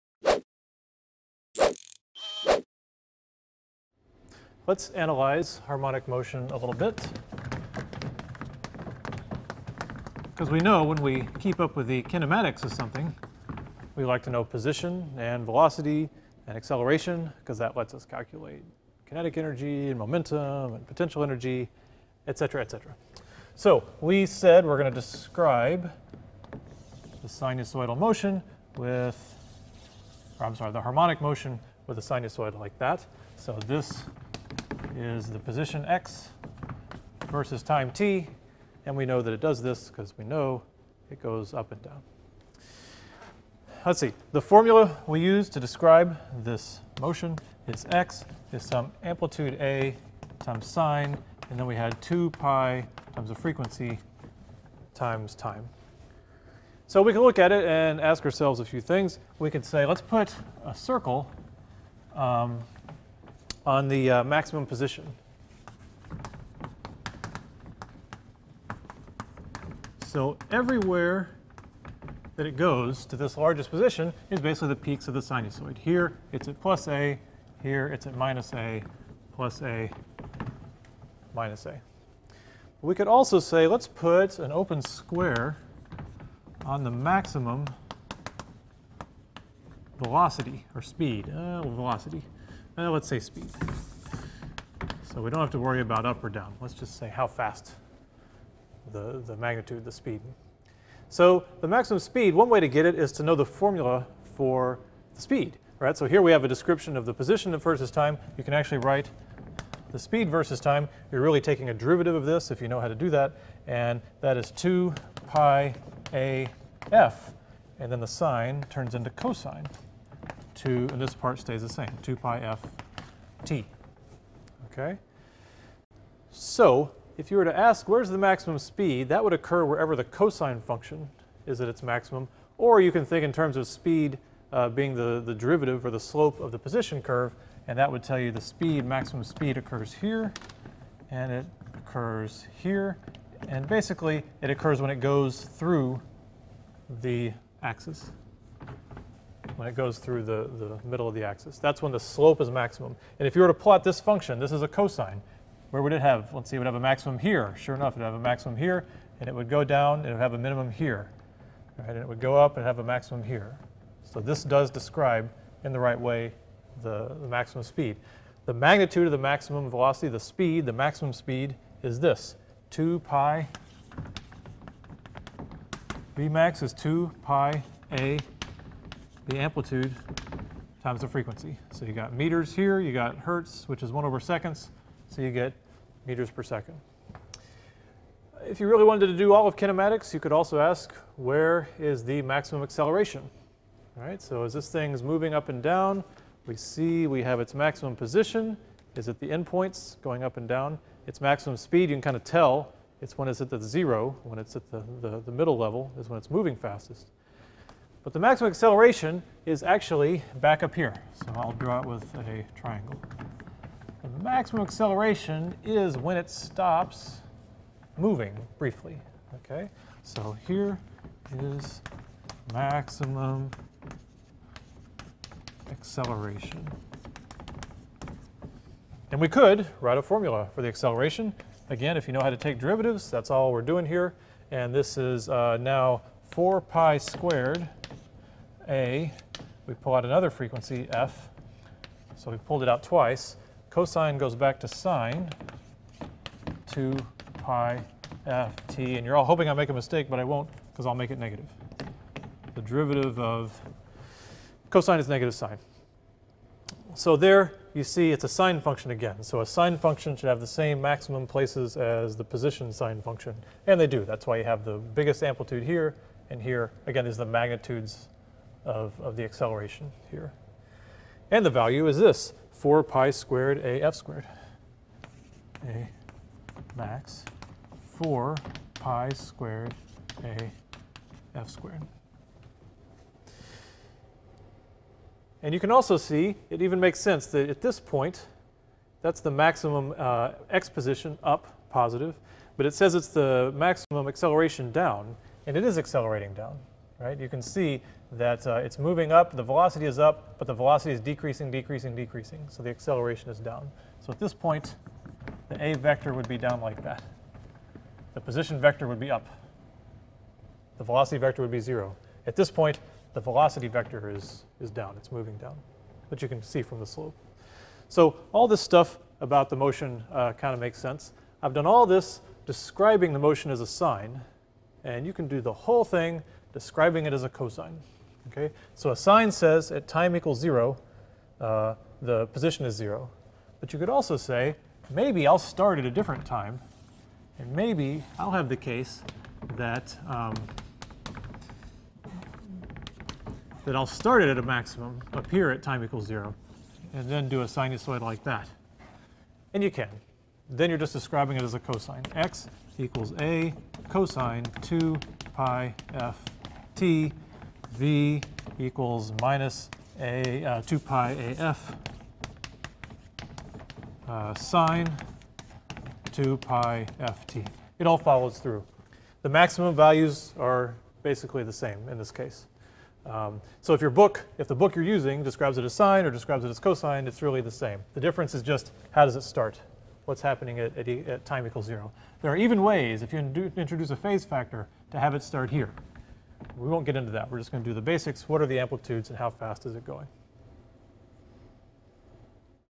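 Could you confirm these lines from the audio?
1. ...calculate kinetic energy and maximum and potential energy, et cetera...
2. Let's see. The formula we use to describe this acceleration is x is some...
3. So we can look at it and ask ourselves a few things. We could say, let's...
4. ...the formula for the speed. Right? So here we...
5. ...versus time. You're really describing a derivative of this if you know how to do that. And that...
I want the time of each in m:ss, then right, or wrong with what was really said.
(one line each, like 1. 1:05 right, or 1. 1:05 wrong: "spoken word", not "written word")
1. 0:18 wrong: "momentum", not "maximum"
2. 0:43 wrong: "motion", not "acceleration"
3. 0:56 right
4. 1:43 right
5. 1:50 wrong: "taking", not "describing".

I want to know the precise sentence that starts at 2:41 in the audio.
Right, and it would go up and have a maximum here.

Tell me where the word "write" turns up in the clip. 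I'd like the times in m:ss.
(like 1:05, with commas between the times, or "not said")
1:48, 3:49.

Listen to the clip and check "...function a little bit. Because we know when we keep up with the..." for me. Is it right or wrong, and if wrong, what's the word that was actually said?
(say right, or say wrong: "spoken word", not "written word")
wrong: "motion", not "function".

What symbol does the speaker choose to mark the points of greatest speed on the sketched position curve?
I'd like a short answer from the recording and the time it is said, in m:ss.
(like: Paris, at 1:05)
open square, at 1:24.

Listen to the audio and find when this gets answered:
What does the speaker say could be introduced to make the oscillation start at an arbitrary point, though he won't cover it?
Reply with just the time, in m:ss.
6:23.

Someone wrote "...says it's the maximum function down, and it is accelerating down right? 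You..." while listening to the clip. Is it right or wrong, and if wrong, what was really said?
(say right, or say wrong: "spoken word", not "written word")
wrong: "acceleration", not "function".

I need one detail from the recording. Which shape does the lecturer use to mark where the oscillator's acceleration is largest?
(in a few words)
triangle.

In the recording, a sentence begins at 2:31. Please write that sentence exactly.
That's when the slope is maximum.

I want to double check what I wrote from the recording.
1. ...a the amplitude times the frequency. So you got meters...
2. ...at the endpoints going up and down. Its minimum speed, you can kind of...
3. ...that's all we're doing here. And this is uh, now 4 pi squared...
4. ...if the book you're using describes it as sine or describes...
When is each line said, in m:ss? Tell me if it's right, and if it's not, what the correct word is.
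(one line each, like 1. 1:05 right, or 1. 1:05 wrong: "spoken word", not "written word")
1. 2:57 right
2. 3:19 wrong: "maximum", not "minimum"
3. 3:53 right
4. 6:14 right.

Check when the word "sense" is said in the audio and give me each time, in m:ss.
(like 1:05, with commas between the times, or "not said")
4:46, 5:20.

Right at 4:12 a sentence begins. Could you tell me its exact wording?
The derivative of cosine is negative sine.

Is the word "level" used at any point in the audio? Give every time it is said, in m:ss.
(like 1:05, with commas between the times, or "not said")
3:25.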